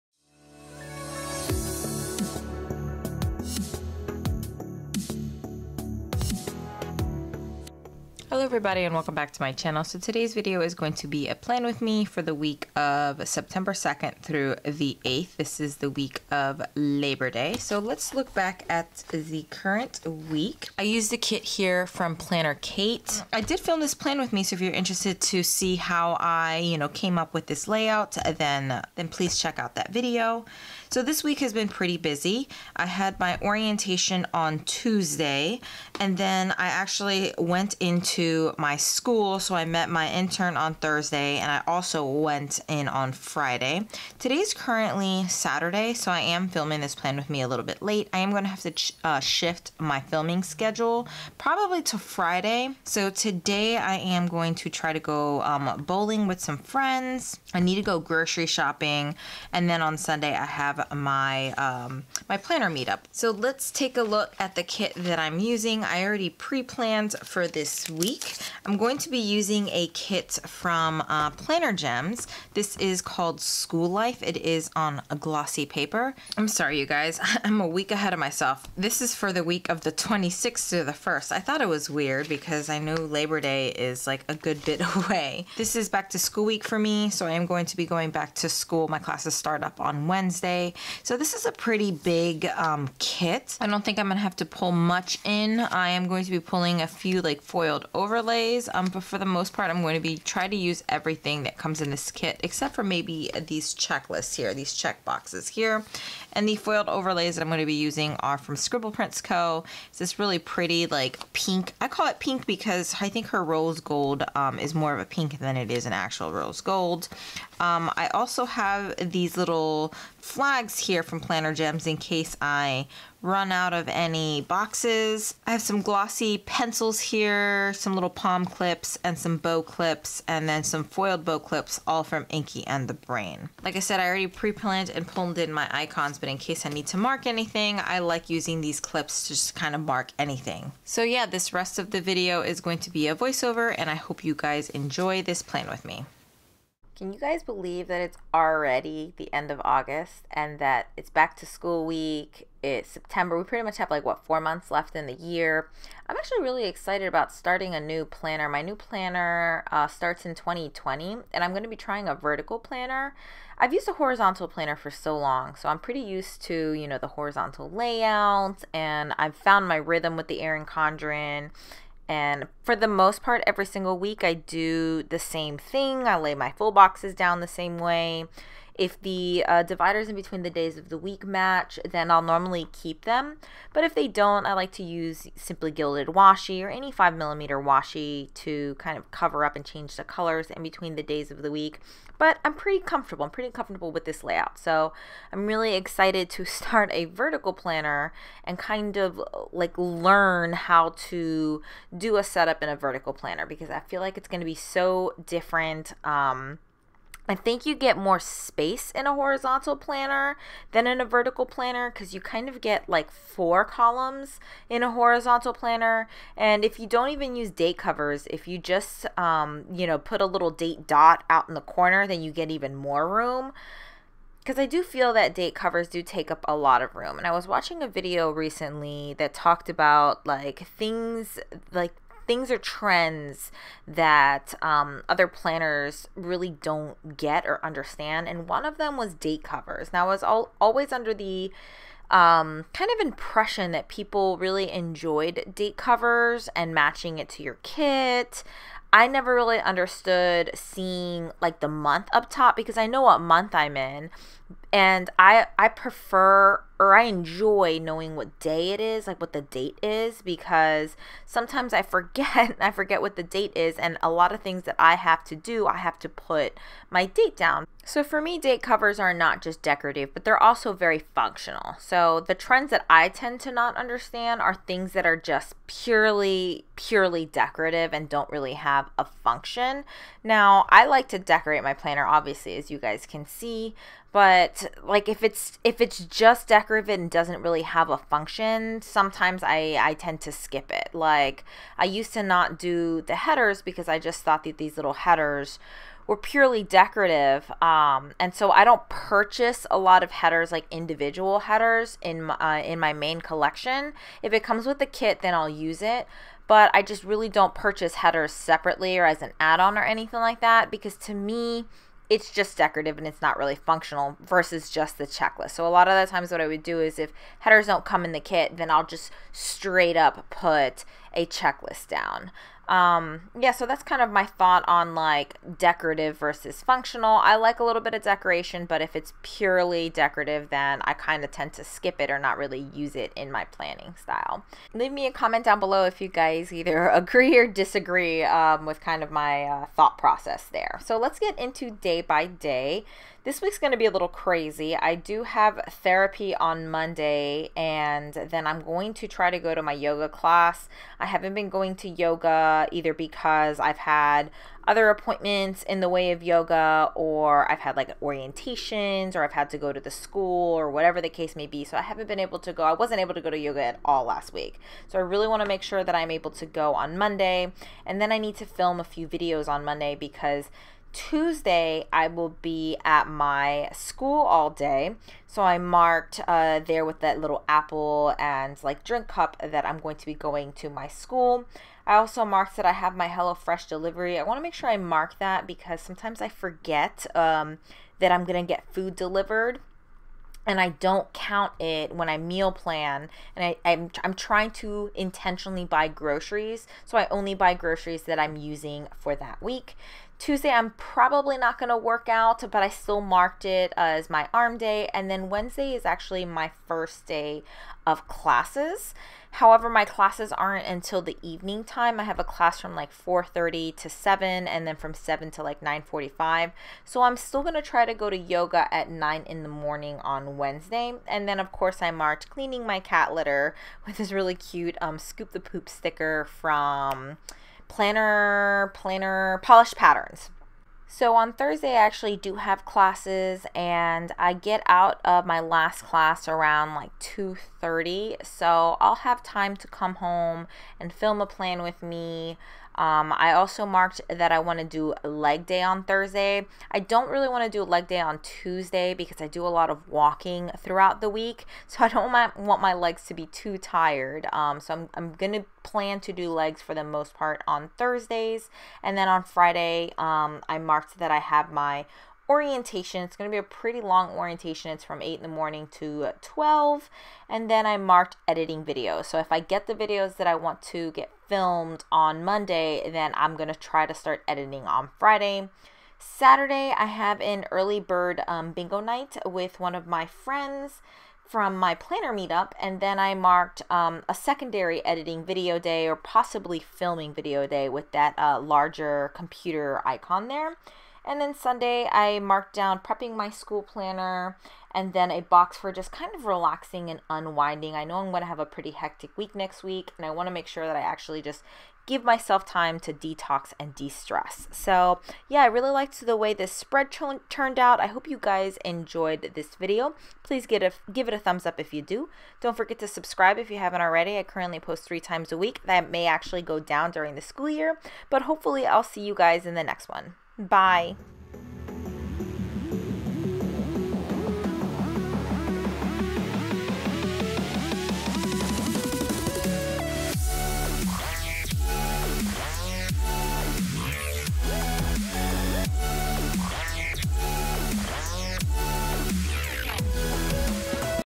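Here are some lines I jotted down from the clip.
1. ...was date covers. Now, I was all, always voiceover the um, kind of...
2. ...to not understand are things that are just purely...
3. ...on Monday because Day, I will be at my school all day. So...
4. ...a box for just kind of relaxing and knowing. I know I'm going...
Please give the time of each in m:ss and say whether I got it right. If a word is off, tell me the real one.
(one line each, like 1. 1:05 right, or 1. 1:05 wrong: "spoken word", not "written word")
1. 3:58 wrong: "under", not "voiceover"
2. 4:33 right
3. 6:09 wrong: "Tuesday", not "Day"
4. 8:15 wrong: "unwinding", not "knowing".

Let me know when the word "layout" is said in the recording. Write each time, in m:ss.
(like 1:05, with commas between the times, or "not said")
0:27, 2:47, 3:14.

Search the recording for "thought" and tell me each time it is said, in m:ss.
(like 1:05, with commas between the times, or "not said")
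1:21, 4:54, 5:24, 5:39.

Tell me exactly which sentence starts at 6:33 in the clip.
And I, I'm, I'm trying to intentionally buy groceries.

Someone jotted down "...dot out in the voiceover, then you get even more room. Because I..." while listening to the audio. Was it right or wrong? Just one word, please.
wrong.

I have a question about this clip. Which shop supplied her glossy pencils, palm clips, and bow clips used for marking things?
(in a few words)
Inky and the Brain.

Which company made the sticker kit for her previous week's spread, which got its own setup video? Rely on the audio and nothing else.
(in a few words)
Planner Kate.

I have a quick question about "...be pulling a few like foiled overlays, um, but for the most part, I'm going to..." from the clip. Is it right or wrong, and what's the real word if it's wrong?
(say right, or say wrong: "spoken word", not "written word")
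right.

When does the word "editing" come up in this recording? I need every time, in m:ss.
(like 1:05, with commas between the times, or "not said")
7:48, 7:54, 8:04.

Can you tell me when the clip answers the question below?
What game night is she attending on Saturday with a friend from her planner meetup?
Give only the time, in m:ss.
7:58.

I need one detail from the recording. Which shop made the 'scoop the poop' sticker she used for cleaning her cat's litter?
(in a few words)
Polished Patterns.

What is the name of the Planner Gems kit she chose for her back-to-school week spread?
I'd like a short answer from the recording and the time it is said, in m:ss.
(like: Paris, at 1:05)
School Life, at 1:13.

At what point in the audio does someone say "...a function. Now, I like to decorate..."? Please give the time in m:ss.
4:38.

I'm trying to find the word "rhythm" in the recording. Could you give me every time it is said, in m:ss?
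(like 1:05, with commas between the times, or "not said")
2:49.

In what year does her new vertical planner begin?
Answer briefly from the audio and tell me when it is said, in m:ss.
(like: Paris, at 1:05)
2020, at 2:40.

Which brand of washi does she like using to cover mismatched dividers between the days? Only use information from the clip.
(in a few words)
Simply Gilded.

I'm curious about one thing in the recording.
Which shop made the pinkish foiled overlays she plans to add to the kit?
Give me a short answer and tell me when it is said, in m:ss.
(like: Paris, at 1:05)
Scribble Prints Co., at 1:48.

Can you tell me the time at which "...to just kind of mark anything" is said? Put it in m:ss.
2:19.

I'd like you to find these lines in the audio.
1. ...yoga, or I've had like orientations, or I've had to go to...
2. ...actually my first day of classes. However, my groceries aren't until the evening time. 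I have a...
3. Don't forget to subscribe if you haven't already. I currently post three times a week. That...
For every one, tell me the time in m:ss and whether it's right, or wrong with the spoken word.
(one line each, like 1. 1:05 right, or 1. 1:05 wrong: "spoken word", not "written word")
1. 5:56 right
2. 6:45 wrong: "classes", not "groceries"
3. 8:32 right.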